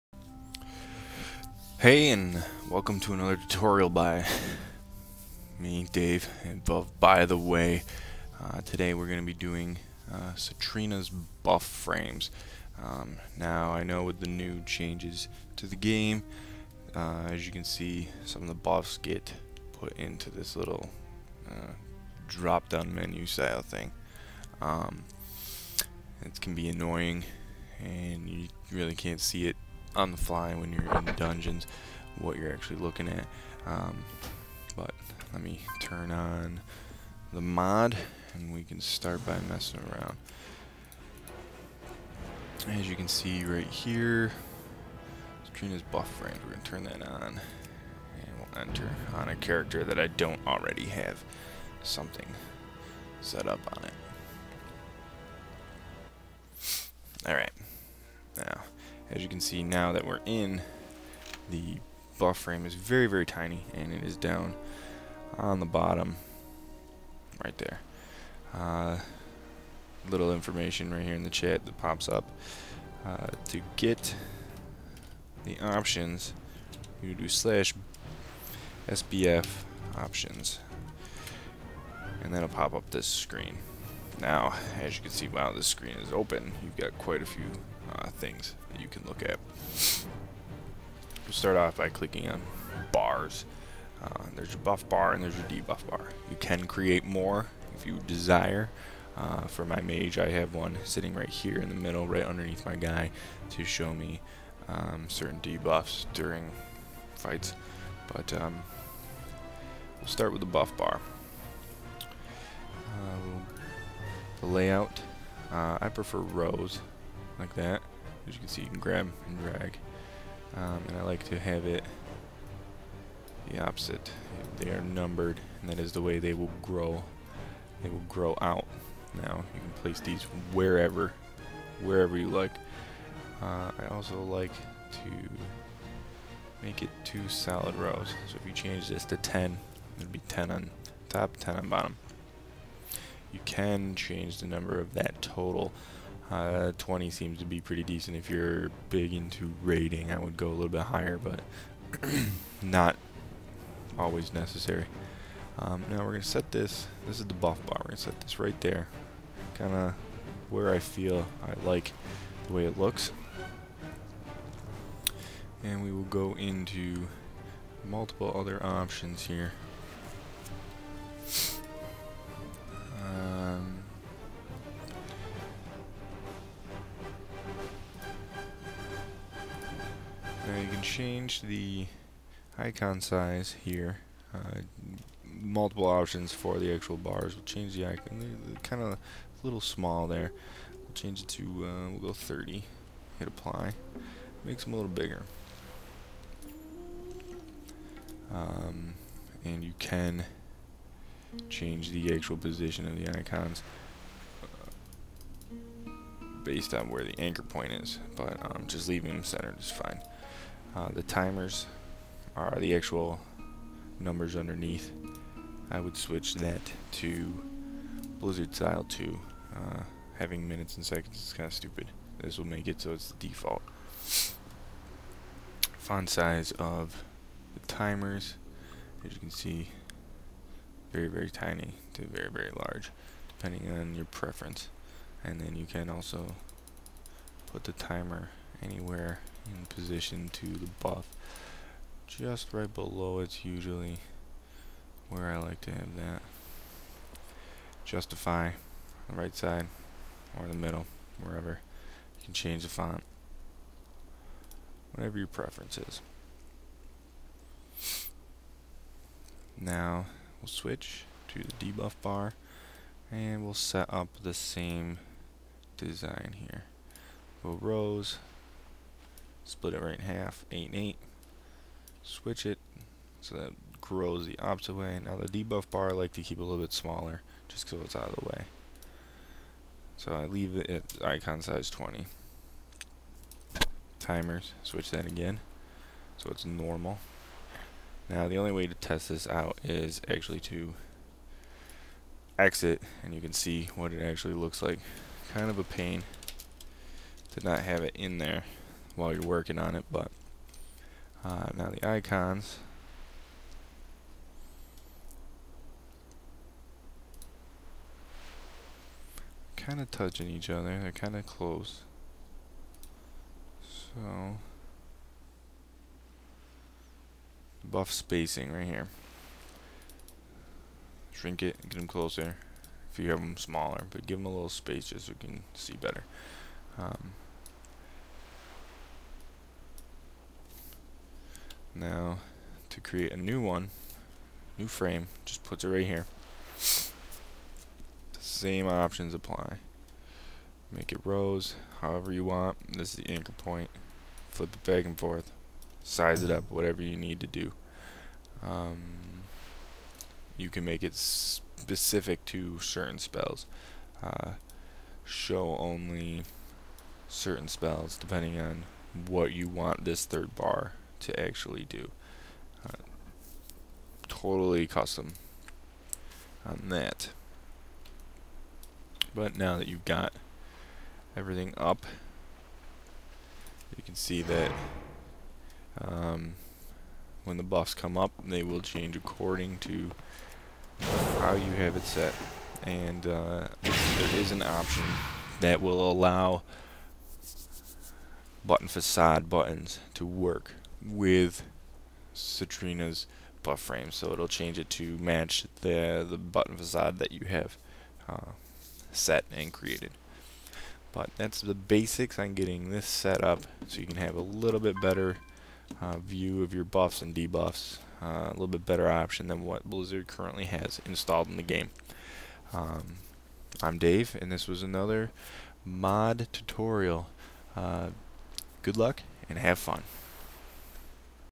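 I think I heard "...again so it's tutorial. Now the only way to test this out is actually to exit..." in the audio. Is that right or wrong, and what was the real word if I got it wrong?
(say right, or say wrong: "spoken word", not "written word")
wrong: "normal", not "tutorial".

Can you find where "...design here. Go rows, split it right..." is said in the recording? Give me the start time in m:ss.
4:25.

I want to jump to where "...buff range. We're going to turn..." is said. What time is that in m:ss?
0:45.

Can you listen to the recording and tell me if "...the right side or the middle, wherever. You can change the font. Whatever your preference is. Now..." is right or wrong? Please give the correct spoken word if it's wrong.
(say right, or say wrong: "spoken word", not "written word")
right.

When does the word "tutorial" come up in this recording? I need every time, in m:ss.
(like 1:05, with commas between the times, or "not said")
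0:03, 6:56.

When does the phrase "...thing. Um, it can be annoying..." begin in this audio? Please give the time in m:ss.
0:23.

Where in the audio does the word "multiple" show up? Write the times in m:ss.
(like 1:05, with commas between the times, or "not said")
2:47, 3:05.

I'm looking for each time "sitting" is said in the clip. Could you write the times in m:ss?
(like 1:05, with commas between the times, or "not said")
1:40.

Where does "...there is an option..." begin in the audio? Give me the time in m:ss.
6:23.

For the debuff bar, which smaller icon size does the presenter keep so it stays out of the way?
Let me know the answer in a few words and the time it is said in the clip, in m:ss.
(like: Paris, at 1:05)
20, at 4:41.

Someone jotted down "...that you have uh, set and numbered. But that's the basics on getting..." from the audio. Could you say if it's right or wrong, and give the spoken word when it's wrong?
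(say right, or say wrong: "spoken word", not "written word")
wrong: "created", not "numbered".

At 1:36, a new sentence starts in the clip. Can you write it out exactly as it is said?
You can create more if you desire.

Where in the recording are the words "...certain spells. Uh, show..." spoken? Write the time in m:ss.
5:52.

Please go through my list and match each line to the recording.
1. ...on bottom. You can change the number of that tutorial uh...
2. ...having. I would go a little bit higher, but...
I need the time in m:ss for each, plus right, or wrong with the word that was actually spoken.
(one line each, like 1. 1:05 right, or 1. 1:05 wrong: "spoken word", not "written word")
1. 2:21 wrong: "total", not "tutorial"
2. 2:29 wrong: "raiding", not "having".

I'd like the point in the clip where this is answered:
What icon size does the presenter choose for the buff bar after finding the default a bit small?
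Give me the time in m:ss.
3:12.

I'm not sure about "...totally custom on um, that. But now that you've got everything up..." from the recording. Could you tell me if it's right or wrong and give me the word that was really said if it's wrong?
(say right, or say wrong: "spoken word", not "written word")
right.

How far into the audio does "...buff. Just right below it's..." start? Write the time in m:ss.
4:00.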